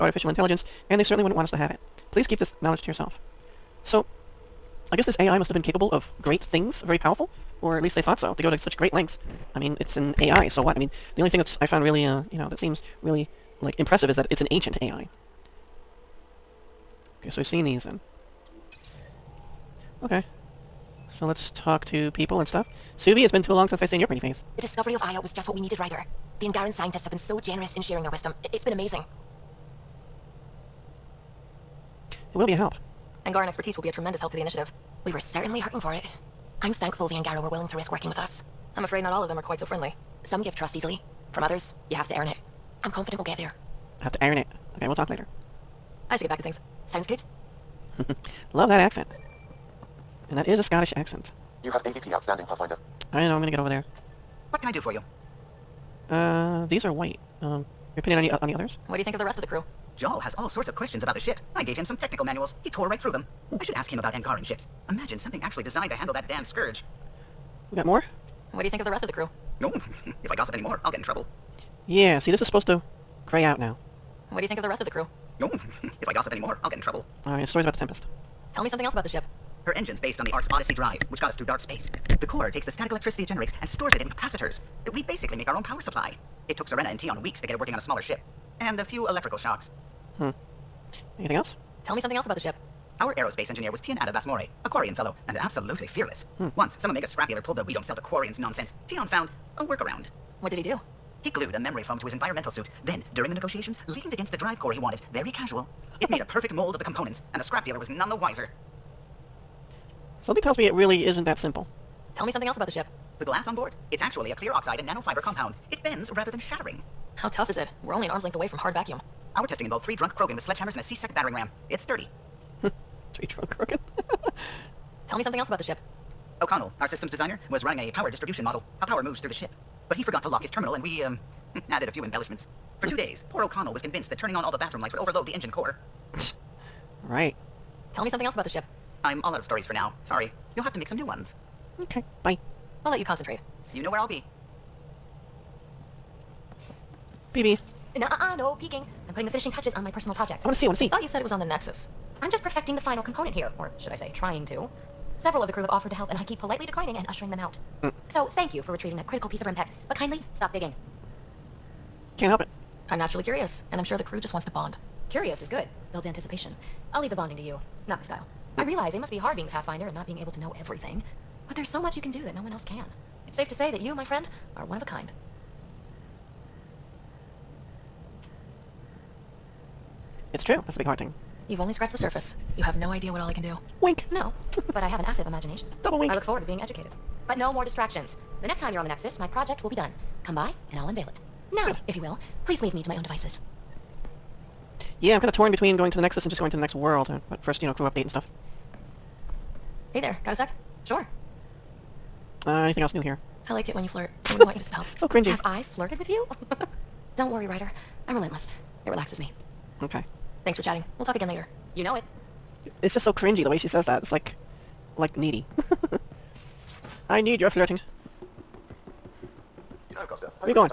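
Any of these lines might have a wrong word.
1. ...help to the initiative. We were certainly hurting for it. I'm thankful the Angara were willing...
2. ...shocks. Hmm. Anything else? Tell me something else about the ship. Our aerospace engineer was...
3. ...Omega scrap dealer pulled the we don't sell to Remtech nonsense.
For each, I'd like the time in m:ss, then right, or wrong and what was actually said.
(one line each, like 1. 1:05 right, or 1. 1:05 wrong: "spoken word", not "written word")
1. 0:34 right
2. 1:29 right
3. 1:36 wrong: "Quarians", not "Remtech".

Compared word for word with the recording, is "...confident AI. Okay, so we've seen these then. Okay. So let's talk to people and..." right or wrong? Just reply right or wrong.
wrong.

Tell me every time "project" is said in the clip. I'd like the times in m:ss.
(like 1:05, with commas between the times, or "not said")
2:30, 3:09.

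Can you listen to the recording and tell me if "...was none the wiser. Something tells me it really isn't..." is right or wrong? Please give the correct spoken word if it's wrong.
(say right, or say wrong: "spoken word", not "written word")
right.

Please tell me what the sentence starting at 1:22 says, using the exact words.
The core takes the static electricity it generates and stores it in capacitors.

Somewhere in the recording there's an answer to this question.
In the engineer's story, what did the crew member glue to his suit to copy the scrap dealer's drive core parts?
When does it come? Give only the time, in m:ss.
1:41.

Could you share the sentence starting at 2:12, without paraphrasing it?
For two days, poor O'Connell was convinced that turning on all the bathroom lights would overload the engine core.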